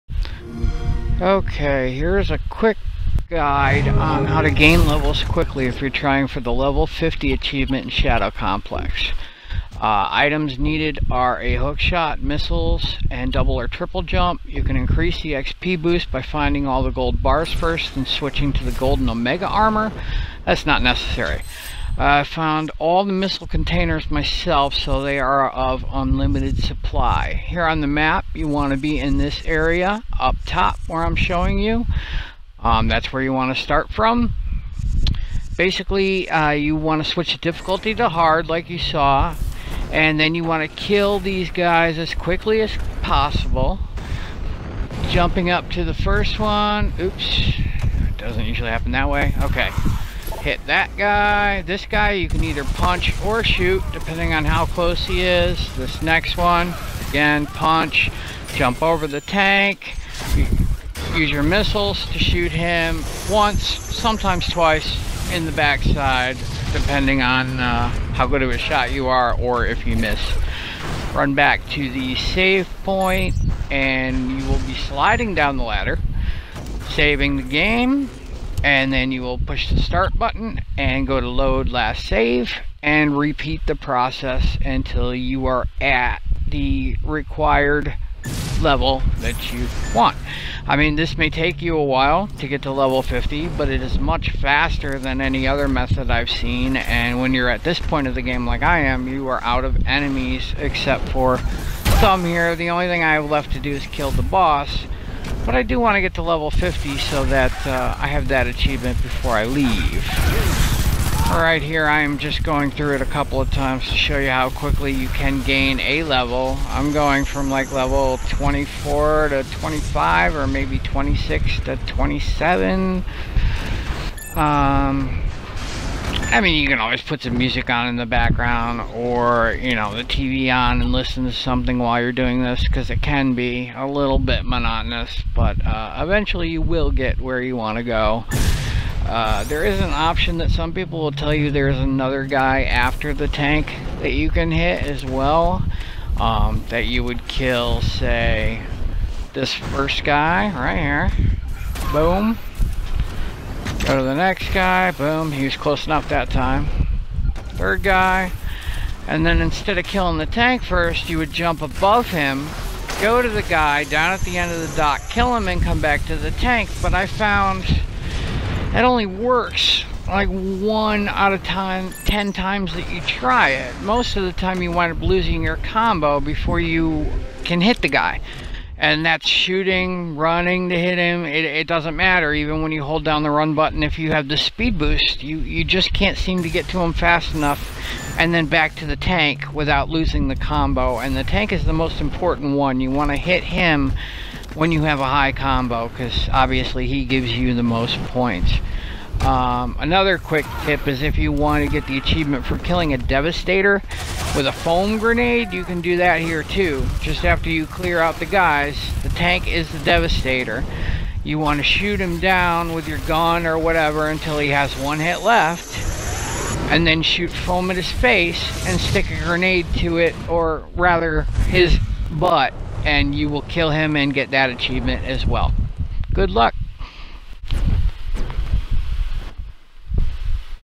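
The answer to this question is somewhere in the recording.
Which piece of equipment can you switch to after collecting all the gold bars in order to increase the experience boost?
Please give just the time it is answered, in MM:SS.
00:18.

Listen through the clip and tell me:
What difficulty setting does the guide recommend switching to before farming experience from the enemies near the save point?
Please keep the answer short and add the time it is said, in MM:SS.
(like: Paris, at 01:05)
Hard, at 00:38.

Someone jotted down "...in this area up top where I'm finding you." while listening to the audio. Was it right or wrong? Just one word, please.
wrong.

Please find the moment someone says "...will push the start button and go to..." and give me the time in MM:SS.
01:19.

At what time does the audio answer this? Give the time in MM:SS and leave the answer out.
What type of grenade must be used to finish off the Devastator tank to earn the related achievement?
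03:24.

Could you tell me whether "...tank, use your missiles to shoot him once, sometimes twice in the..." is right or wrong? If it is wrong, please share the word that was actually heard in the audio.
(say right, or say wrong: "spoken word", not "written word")
right.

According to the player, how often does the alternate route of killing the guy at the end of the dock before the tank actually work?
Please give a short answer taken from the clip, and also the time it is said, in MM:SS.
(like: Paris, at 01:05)
1 in 10 times, at 02:50.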